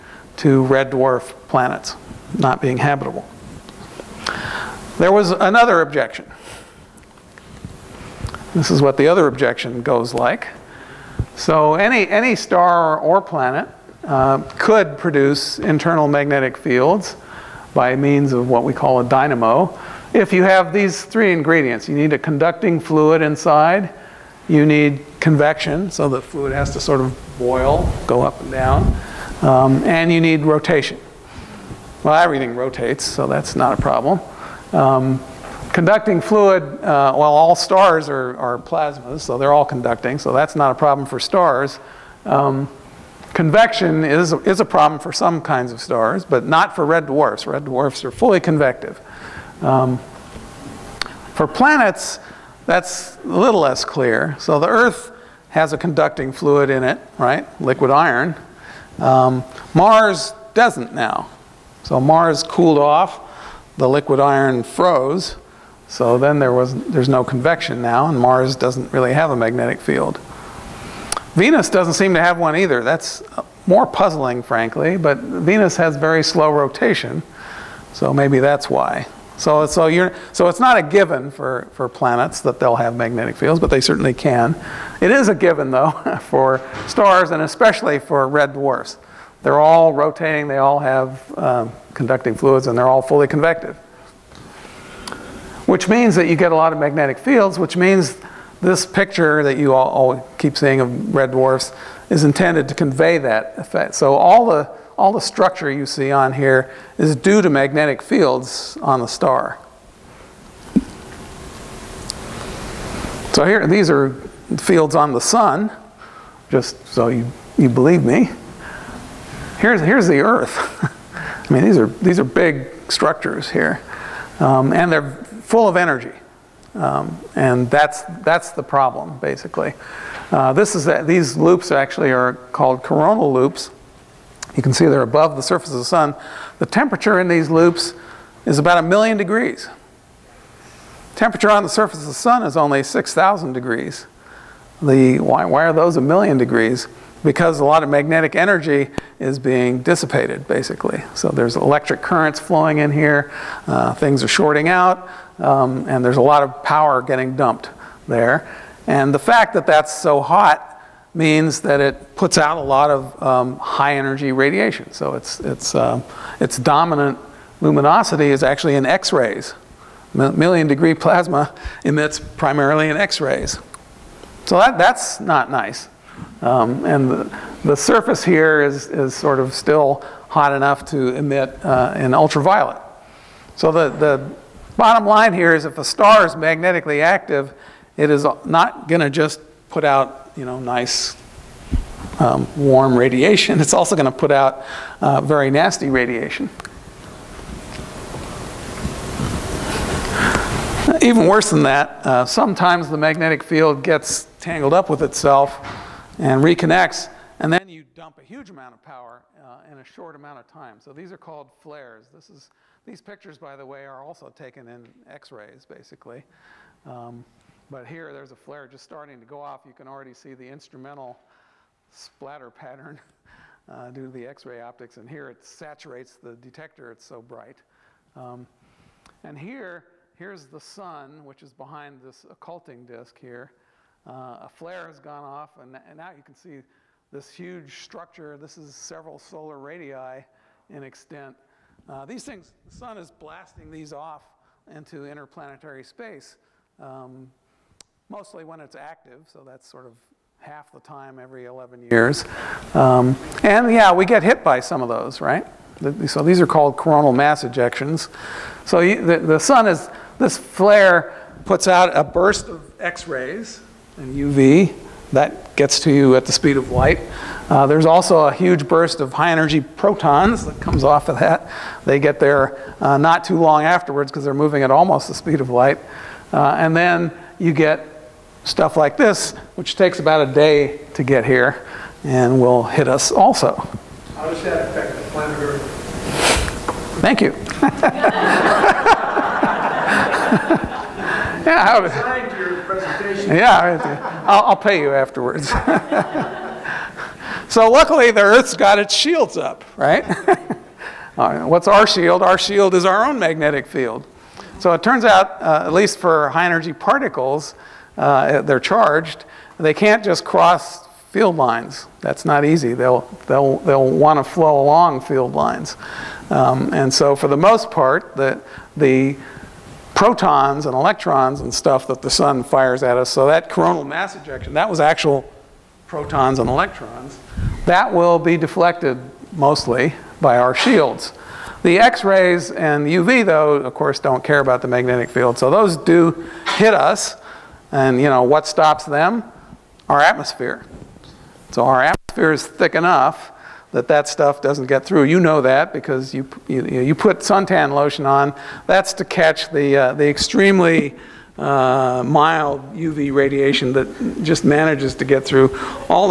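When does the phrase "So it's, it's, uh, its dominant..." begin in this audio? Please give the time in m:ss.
2:44.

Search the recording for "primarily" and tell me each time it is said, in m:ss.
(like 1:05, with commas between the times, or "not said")
2:52.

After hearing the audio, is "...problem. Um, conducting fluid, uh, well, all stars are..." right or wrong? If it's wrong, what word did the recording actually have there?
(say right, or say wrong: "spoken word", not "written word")
right.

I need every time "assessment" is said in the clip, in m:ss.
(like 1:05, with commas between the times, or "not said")
not said.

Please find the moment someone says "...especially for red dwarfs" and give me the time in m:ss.
1:27.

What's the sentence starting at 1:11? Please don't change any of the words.
Venus doesn't seem to have one either.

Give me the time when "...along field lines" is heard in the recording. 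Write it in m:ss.
5:14.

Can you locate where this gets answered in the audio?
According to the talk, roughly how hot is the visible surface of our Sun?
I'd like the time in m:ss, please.
2:22.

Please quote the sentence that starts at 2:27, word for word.
Because a lot of magnetic energy is being dissipated, basically.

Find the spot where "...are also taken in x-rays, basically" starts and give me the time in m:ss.
3:33.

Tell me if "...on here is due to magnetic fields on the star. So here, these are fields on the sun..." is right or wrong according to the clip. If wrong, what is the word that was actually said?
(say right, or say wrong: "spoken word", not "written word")
right.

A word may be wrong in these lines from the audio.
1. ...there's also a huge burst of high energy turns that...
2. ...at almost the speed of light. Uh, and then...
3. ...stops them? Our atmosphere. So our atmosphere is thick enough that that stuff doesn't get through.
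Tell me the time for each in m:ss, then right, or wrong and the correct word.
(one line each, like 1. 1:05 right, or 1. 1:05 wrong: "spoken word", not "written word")
1. 4:27 wrong: "protons", not "turns"
2. 4:34 right
3. 5:38 right.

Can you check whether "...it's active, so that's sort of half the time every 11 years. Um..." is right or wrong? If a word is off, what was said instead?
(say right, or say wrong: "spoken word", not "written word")
right.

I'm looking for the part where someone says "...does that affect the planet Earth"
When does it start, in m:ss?
4:44.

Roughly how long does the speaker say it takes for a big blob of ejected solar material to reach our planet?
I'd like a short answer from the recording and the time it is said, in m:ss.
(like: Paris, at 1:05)
about a day, at 4:39.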